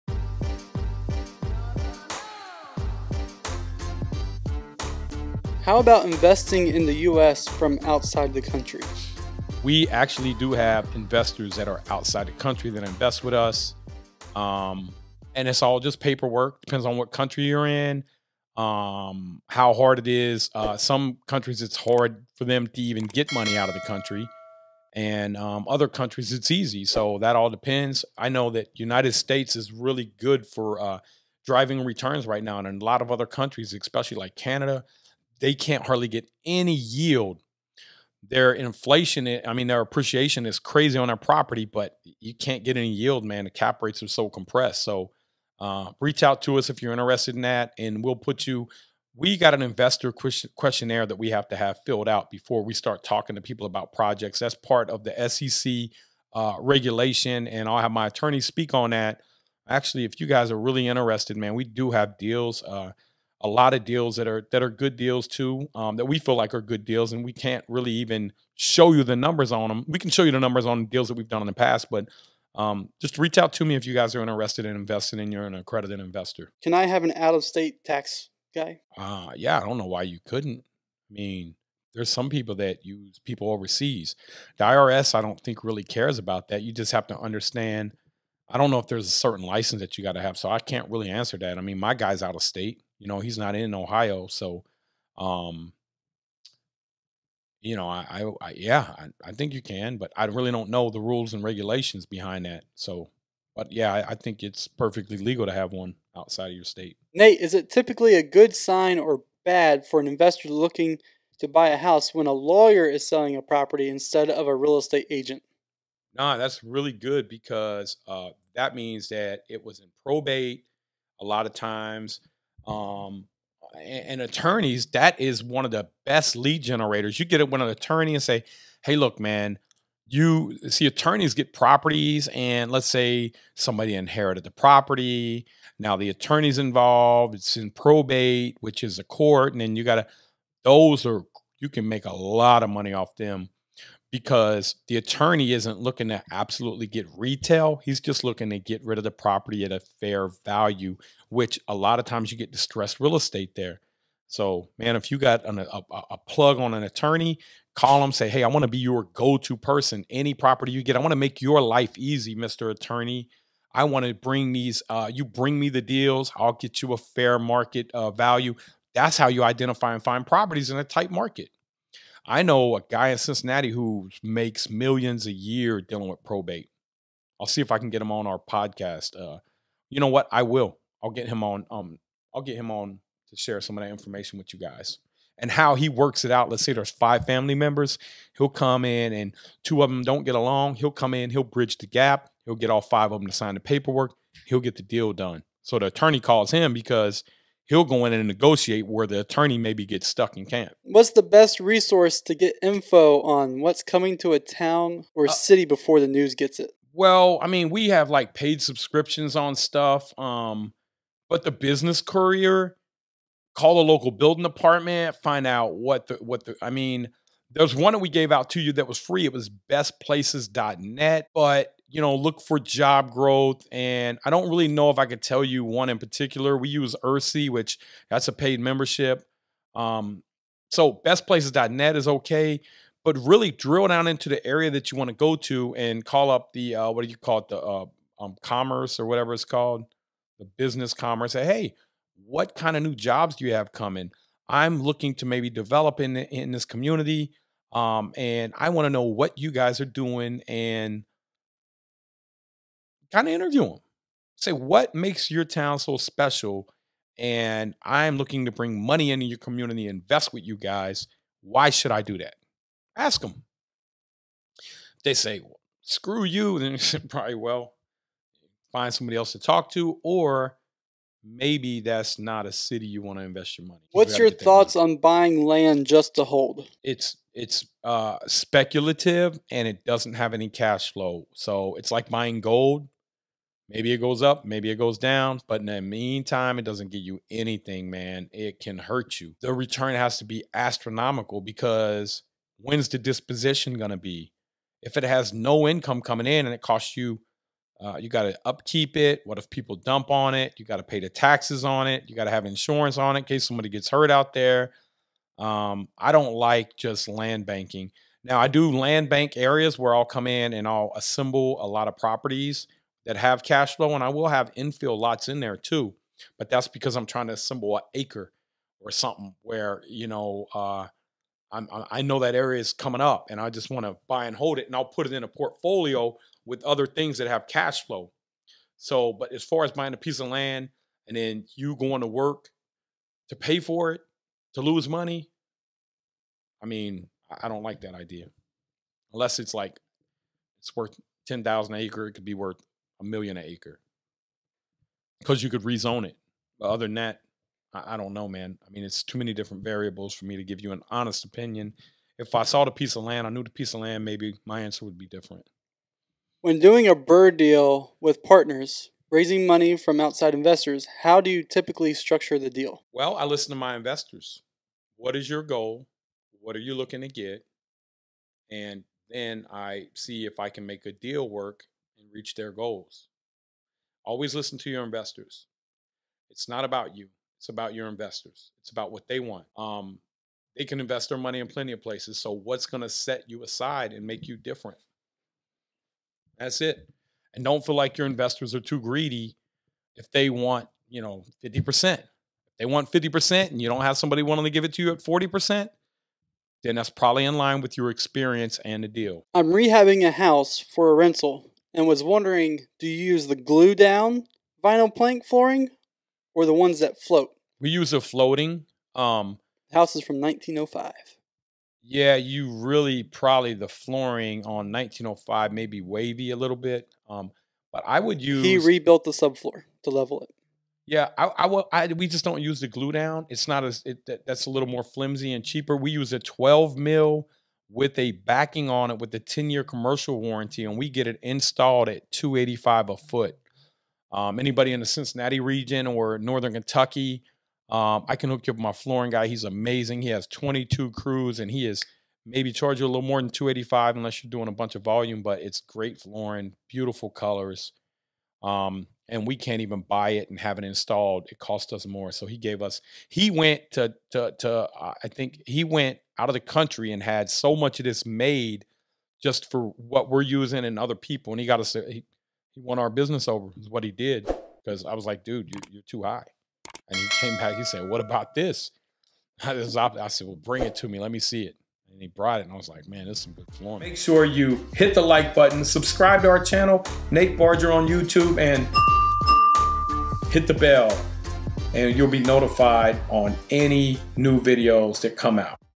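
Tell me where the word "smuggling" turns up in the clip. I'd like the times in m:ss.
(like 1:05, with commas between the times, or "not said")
not said.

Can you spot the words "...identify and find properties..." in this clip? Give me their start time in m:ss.
2:49.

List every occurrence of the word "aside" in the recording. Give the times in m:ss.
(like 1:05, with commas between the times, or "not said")
6:23.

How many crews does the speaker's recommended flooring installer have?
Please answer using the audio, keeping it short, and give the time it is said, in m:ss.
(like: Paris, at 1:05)
22, at 7:20.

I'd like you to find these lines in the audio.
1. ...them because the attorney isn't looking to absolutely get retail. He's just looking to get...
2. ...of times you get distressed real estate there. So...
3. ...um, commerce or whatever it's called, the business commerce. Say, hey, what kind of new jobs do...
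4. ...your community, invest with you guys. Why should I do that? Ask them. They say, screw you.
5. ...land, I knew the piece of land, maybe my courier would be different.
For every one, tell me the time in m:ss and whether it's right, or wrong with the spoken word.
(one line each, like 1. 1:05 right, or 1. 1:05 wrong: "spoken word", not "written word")
1. 2:23 right
2. 2:31 right
3. 3:58 right
4. 4:19 right
5. 5:53 wrong: "answer", not "courier".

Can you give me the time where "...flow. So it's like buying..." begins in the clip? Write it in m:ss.
4:40.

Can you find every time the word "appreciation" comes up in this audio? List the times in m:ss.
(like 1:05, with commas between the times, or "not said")
0:39.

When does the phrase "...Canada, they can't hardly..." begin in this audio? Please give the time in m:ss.
0:34.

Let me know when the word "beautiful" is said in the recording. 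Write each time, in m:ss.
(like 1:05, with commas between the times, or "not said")
7:26.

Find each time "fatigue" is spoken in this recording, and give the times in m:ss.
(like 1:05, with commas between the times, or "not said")
not said.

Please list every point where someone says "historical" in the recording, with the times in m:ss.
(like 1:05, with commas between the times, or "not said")
not said.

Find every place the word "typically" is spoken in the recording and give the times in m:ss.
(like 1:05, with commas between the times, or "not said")
1:47, 6:01.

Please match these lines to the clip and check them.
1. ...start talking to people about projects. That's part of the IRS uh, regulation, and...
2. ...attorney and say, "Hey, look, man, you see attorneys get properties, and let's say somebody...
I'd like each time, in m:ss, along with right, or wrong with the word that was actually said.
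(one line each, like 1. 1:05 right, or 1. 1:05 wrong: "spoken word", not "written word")
1. 0:52 wrong: "SEC", not "IRS"
2. 2:07 right.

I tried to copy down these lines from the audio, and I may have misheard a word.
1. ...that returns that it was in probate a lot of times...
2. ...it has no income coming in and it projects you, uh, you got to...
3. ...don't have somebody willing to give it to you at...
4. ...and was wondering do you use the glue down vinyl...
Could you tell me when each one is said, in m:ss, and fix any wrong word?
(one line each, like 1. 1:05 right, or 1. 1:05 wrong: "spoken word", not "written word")
1. 1:58 wrong: "means", not "returns"
2. 4:54 wrong: "costs", not "projects"
3. 6:33 right
4. 6:41 right.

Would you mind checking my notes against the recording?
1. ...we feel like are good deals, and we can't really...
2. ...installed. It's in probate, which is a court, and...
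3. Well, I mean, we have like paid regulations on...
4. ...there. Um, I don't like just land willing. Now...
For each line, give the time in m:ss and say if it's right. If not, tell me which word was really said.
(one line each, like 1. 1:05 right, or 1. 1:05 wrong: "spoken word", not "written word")
1. 1:06 right
2. 2:16 wrong: "involved", not "installed"
3. 3:26 wrong: "subscriptions", not "regulations"
4. 5:04 wrong: "banking", not "willing".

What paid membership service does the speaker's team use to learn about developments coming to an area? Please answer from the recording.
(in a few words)
ERC.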